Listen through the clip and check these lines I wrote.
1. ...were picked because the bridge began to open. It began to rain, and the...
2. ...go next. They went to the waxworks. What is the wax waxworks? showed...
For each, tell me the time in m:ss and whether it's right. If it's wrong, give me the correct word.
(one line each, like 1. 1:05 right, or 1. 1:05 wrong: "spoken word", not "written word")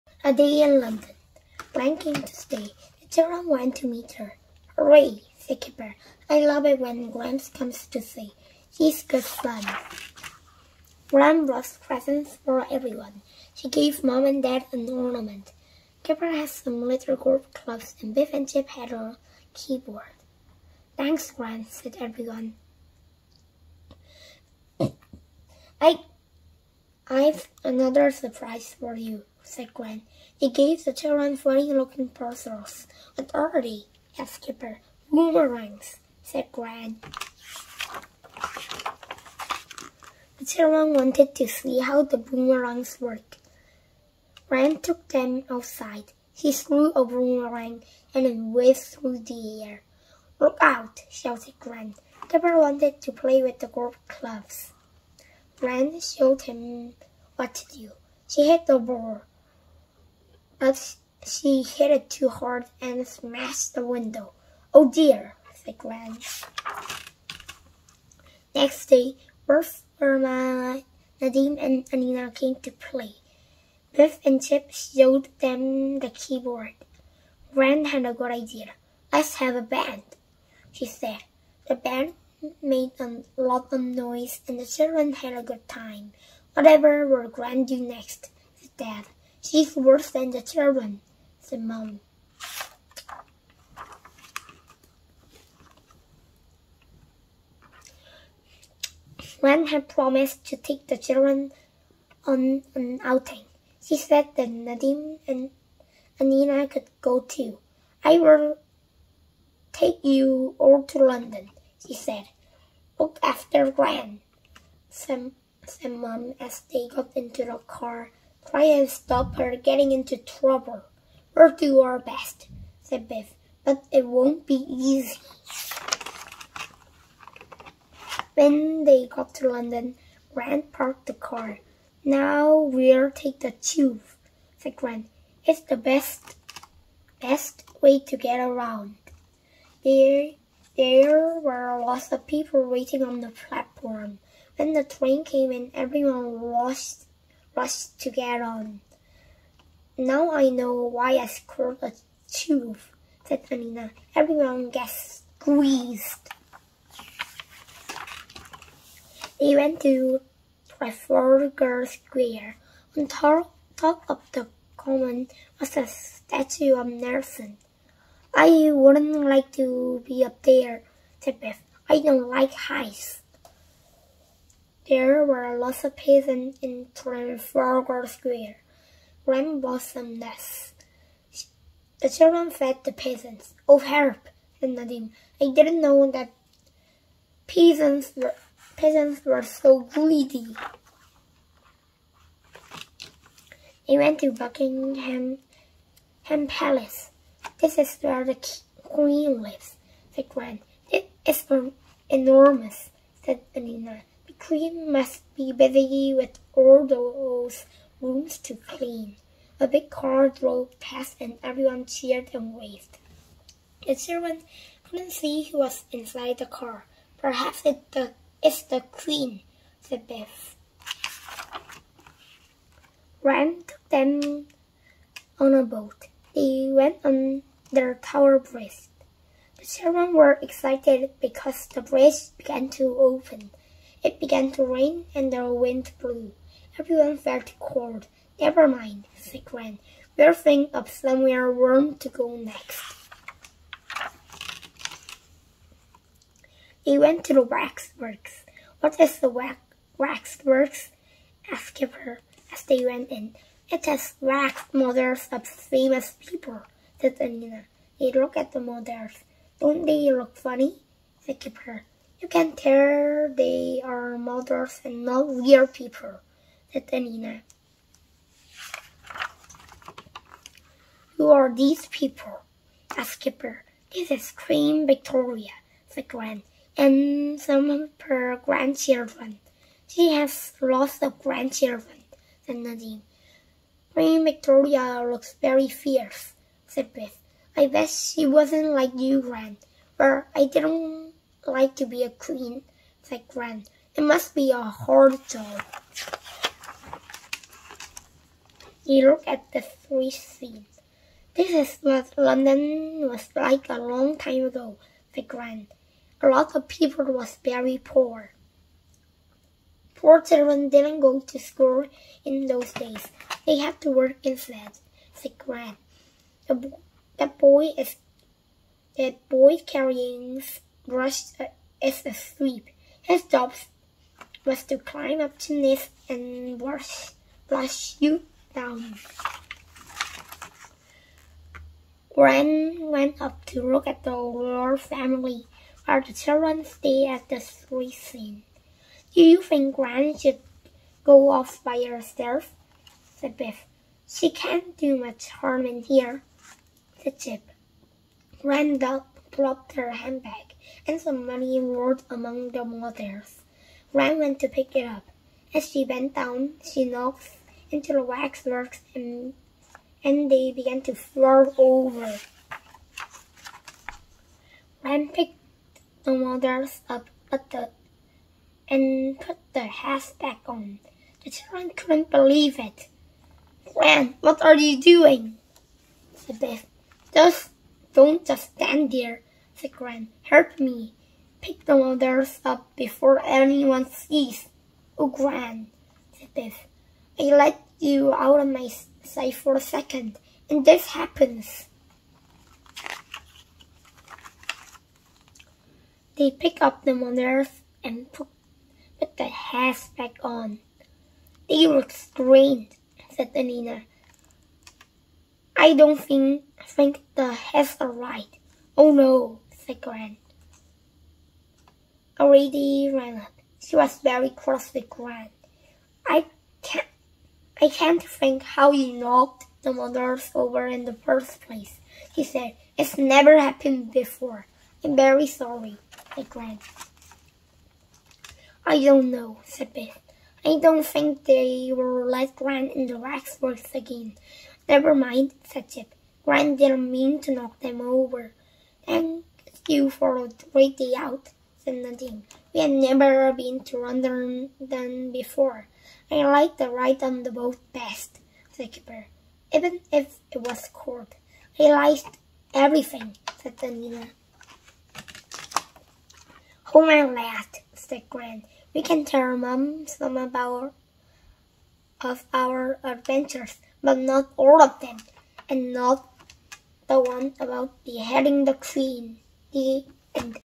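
1. 3:50 wrong: "excited", not "picked"
2. 4:02 wrong: "asked", not "showed".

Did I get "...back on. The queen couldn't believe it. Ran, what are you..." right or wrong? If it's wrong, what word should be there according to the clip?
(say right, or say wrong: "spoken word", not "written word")
wrong: "children", not "queen".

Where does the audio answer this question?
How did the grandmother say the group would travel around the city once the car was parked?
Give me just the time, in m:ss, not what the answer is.
2:13.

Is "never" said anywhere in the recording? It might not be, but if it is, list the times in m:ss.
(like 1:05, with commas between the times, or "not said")
3:58, 7:02, 7:14, 7:22.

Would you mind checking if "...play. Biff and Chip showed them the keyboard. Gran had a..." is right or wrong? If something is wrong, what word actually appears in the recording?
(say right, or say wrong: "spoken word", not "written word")
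right.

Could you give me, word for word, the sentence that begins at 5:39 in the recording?
Do you think Gran should go off by herself?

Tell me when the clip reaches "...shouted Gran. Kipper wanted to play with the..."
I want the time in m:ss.
0:51.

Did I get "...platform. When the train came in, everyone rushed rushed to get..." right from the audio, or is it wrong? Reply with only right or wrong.
right.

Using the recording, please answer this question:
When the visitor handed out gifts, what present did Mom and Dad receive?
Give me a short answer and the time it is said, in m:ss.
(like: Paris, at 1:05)
An ornament, at 0:14.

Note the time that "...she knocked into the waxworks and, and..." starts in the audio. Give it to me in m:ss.
5:56.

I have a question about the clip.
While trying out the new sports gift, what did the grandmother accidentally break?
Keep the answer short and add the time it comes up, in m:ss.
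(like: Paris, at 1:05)
The window, at 1:03.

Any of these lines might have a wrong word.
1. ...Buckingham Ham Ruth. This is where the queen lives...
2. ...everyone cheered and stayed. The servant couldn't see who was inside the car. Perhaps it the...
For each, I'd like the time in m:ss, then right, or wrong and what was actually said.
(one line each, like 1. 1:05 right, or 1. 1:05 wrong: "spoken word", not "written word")
1. 3:14 wrong: "Palace", not "Ruth"
2. 3:31 wrong: "waved", not "stayed".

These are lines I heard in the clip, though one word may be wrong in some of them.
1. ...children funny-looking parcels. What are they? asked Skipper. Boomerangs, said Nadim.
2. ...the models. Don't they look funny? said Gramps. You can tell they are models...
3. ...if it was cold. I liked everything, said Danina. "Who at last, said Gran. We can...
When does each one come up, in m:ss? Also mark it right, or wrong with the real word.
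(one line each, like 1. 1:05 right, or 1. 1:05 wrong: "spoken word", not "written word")
1. 0:30 wrong: "Gwen", not "Nadim"
2. 4:18 wrong: "Kipper", not "Gramps"
3. 7:29 right.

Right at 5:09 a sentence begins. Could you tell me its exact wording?
Poor children didn't go to school in those days.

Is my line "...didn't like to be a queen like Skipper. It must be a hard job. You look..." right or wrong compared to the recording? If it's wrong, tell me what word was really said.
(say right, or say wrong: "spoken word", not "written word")
wrong: "Gran", not "Skipper".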